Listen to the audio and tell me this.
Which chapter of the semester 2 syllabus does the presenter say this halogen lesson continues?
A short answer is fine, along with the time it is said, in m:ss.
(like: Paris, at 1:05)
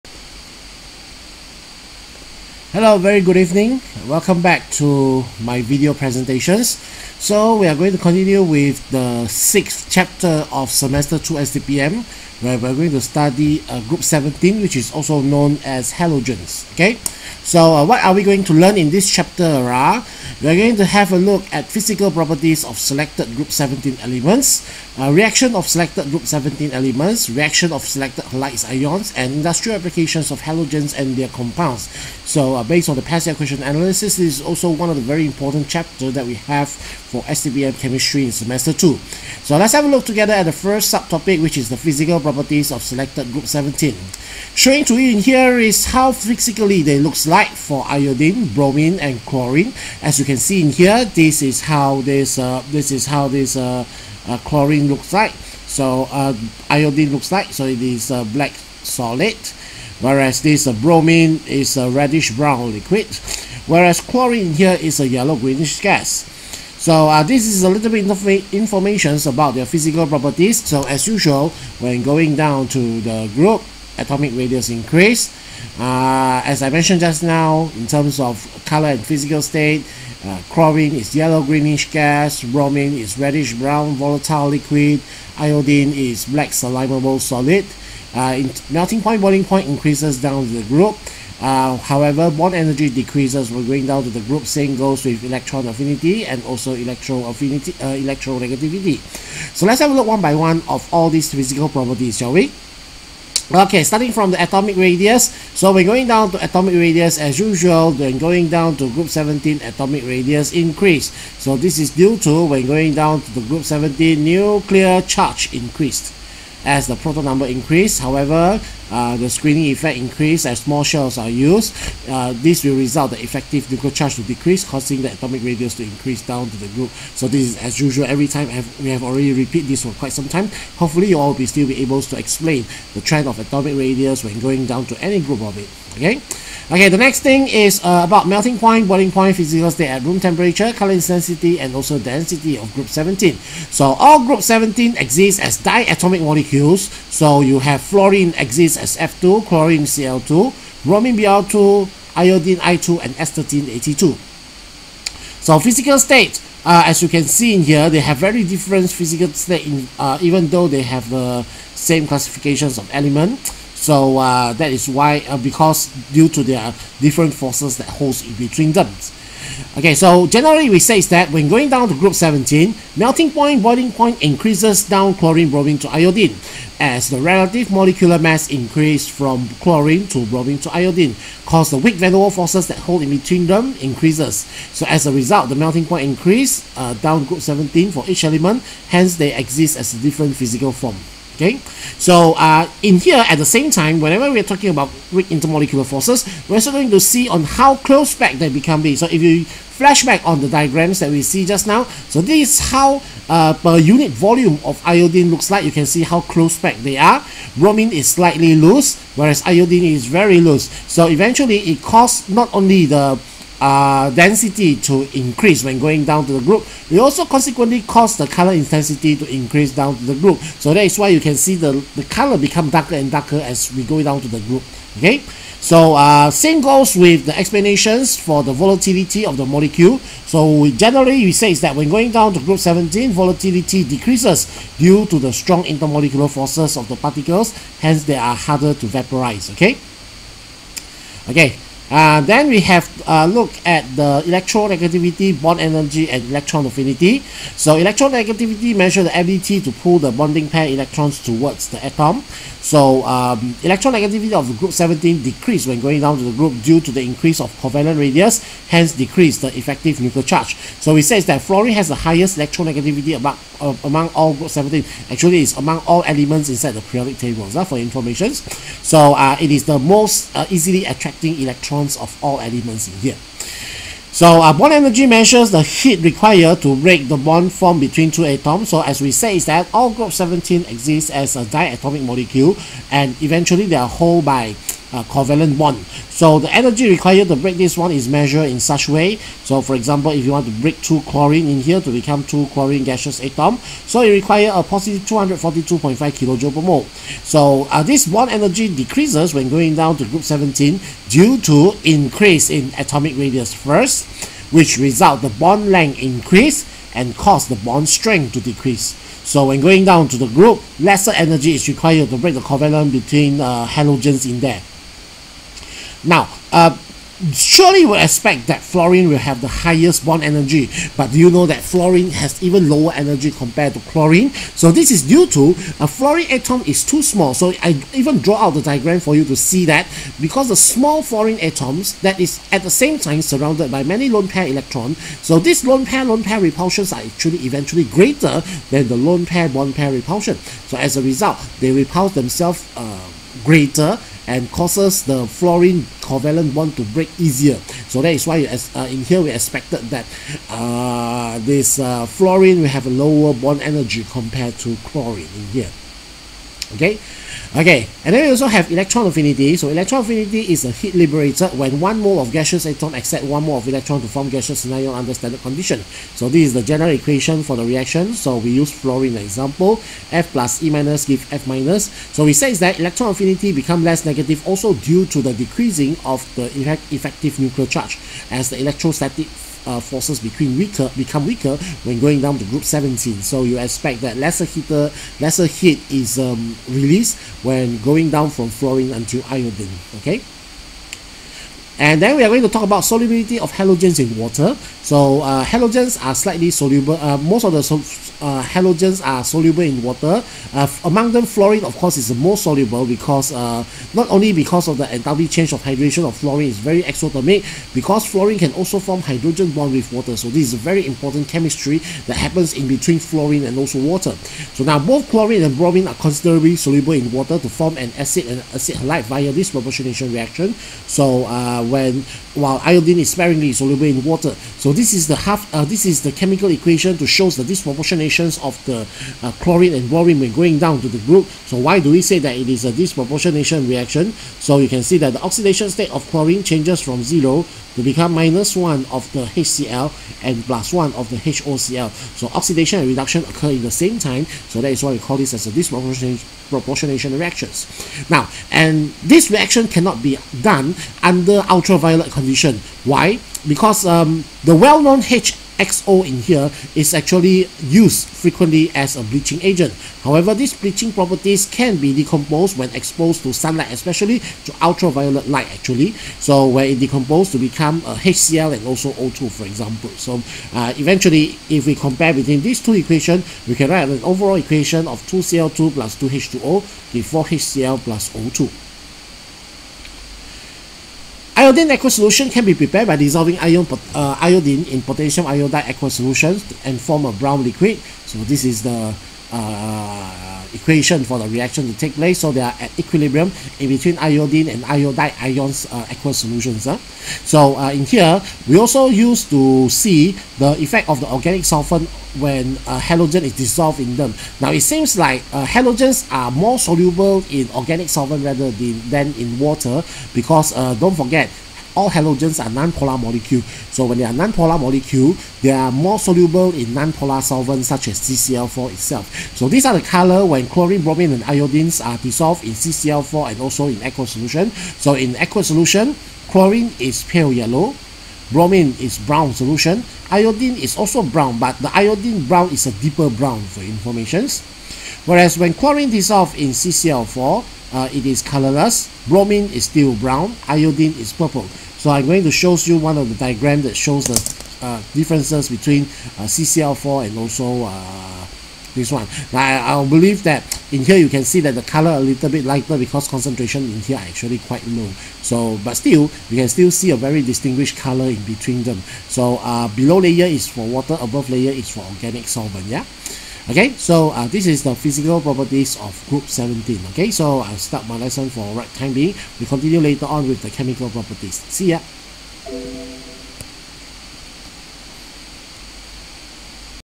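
sixth, at 0:09.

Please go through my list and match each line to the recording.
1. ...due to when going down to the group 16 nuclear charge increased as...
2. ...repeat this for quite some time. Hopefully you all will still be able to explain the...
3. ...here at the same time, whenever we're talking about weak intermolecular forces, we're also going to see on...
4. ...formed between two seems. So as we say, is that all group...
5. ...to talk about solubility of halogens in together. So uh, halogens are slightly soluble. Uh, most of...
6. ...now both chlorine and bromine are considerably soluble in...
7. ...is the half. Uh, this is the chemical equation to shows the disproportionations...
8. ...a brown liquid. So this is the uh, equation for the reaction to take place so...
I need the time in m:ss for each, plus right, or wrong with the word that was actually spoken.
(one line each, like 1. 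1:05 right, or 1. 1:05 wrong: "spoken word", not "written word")
1. 1:51 wrong: "17", not "16"
2. 2:09 right
3. 3:12 right
4. 4:37 wrong: "atoms", not "seems"
5. 6:32 wrong: "water", not "together"
6. 6:54 right
7. 7:04 right
8. 8:07 right.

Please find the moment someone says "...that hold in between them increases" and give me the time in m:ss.
3:02.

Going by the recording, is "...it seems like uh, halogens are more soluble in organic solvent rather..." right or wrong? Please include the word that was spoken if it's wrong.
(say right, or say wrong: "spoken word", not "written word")
right.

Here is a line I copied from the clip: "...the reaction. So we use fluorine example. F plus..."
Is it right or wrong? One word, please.
right.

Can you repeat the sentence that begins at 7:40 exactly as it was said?
However, these bleaching properties can be decomposed when exposed to sunlight, especially to ultraviolet light actually.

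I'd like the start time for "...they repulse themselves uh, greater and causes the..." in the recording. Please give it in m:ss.
5:41.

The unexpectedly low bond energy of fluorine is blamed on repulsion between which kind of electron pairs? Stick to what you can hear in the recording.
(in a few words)
lone pair lone pair.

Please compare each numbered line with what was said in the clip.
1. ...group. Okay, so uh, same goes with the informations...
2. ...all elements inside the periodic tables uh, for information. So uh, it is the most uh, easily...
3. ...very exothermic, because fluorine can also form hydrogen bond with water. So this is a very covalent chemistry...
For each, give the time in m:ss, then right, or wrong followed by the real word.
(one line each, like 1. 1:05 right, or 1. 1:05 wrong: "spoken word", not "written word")
1. 3:44 wrong: "explanations", not "informations"
2. 4:25 right
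3. 6:46 wrong: "important", not "covalent".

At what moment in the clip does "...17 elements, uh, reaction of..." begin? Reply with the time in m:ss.
0:23.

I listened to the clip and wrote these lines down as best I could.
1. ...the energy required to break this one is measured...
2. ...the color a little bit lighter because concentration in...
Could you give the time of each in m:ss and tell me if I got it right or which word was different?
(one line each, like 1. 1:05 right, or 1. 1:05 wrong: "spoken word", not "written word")
1. 4:46 right
2. 9:11 right.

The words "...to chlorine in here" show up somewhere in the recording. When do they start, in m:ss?
5:54.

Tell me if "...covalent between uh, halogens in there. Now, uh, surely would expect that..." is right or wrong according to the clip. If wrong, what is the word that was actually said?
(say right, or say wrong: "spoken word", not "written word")
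right.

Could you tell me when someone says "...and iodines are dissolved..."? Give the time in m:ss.
8:41.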